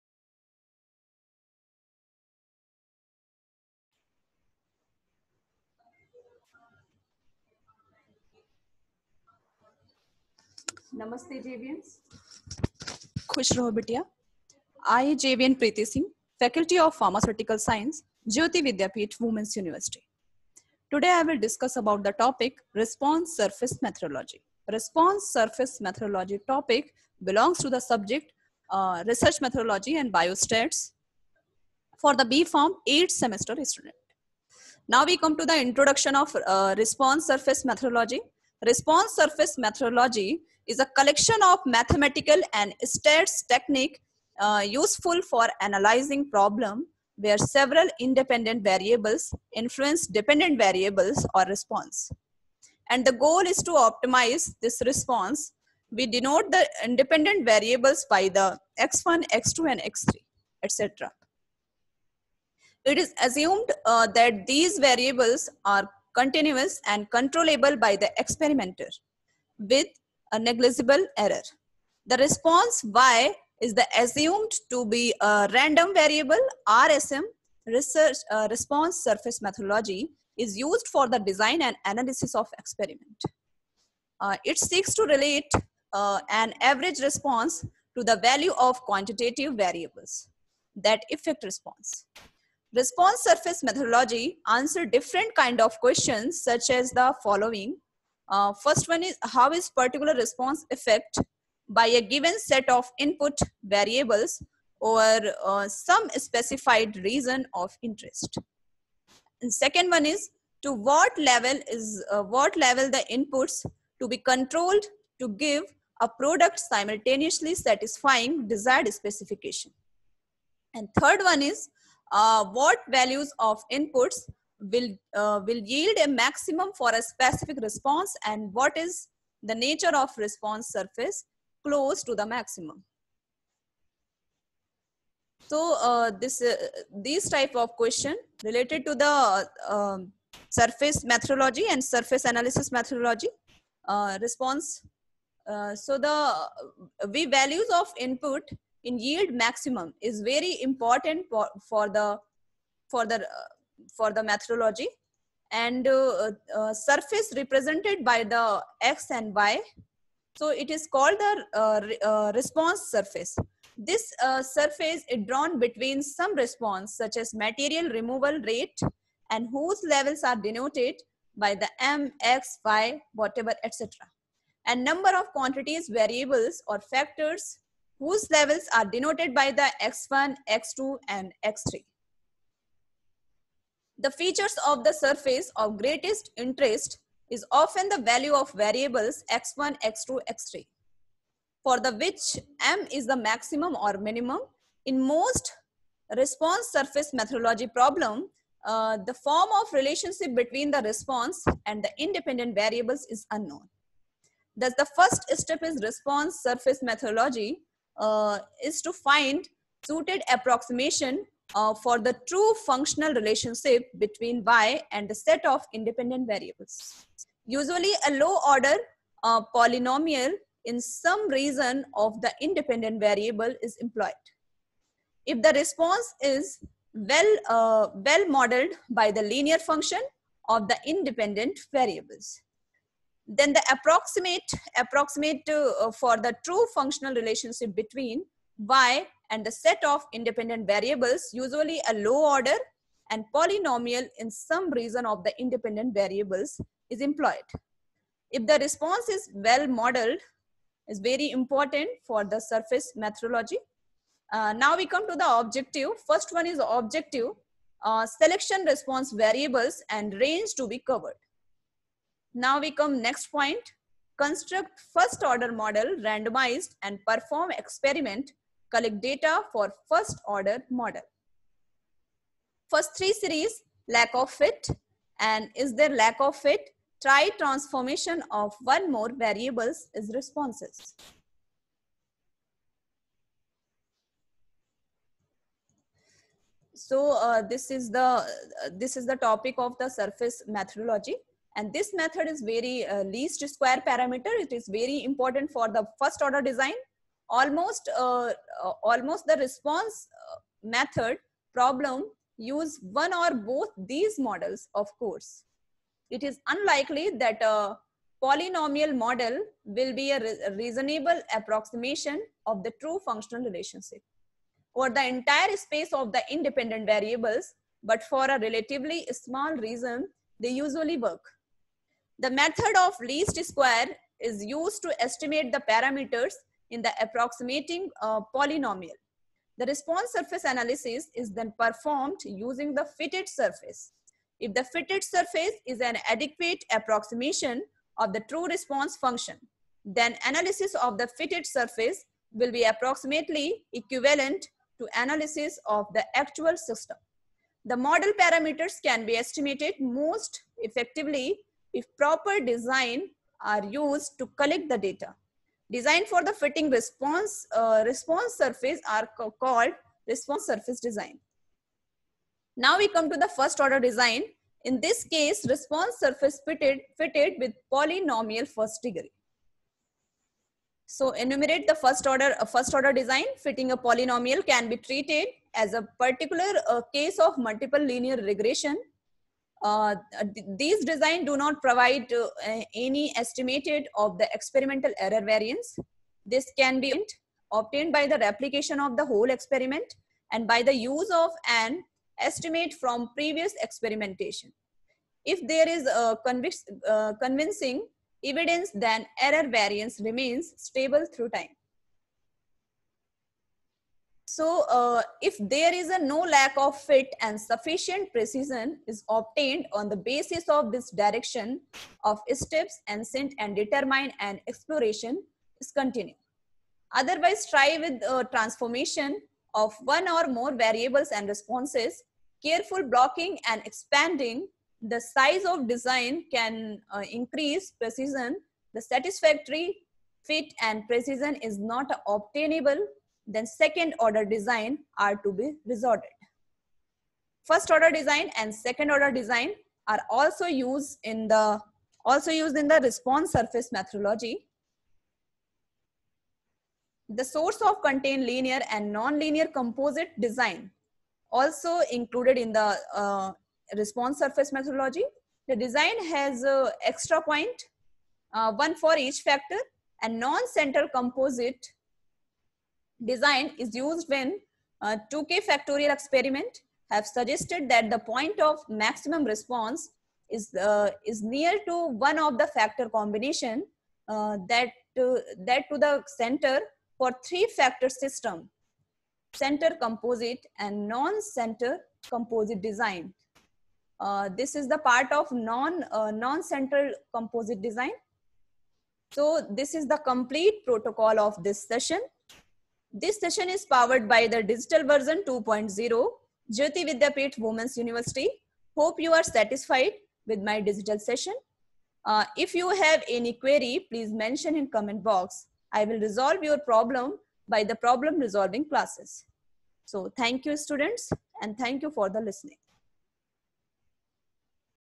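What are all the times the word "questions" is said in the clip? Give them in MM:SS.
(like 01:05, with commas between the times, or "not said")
01:35, 02:17.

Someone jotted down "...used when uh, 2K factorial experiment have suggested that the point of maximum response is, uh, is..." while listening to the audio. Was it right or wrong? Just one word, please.
right.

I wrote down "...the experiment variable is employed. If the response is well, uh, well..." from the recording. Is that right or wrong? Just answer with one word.
wrong.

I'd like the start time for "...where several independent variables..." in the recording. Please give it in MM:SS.
00:47.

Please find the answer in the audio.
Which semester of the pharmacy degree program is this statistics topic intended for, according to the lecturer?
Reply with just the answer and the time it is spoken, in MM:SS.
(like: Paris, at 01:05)
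8th semester, at 00:32.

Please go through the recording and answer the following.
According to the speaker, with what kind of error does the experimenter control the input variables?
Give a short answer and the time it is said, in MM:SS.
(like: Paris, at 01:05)
negligible error, at 01:10.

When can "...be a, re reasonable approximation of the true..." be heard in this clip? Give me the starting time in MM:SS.
05:10.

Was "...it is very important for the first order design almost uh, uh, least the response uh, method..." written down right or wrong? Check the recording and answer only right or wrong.
wrong.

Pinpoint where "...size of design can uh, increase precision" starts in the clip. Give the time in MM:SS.
07:05.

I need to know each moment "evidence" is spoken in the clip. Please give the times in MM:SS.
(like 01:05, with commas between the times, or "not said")
06:38.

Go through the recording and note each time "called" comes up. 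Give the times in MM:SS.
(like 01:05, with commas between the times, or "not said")
02:40, 05:59.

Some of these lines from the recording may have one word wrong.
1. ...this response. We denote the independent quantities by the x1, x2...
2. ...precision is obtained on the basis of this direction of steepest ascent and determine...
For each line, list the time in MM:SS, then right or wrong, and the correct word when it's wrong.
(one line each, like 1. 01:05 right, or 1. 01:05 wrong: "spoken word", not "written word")
1. 00:54 wrong: "variables", not "quantities"
2. 06:48 right.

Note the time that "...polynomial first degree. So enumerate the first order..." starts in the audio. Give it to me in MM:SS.
06:07.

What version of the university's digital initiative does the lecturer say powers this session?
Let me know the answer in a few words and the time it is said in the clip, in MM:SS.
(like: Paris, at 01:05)
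2.0, at 08:14.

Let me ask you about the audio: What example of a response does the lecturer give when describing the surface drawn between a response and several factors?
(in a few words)
material removal rate.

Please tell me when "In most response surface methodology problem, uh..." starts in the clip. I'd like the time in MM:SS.
03:14.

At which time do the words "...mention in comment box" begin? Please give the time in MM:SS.
08:24.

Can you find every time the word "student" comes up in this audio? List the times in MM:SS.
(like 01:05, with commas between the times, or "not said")
00:33, 08:30.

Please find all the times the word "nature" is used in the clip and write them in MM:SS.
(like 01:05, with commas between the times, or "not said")
02:09.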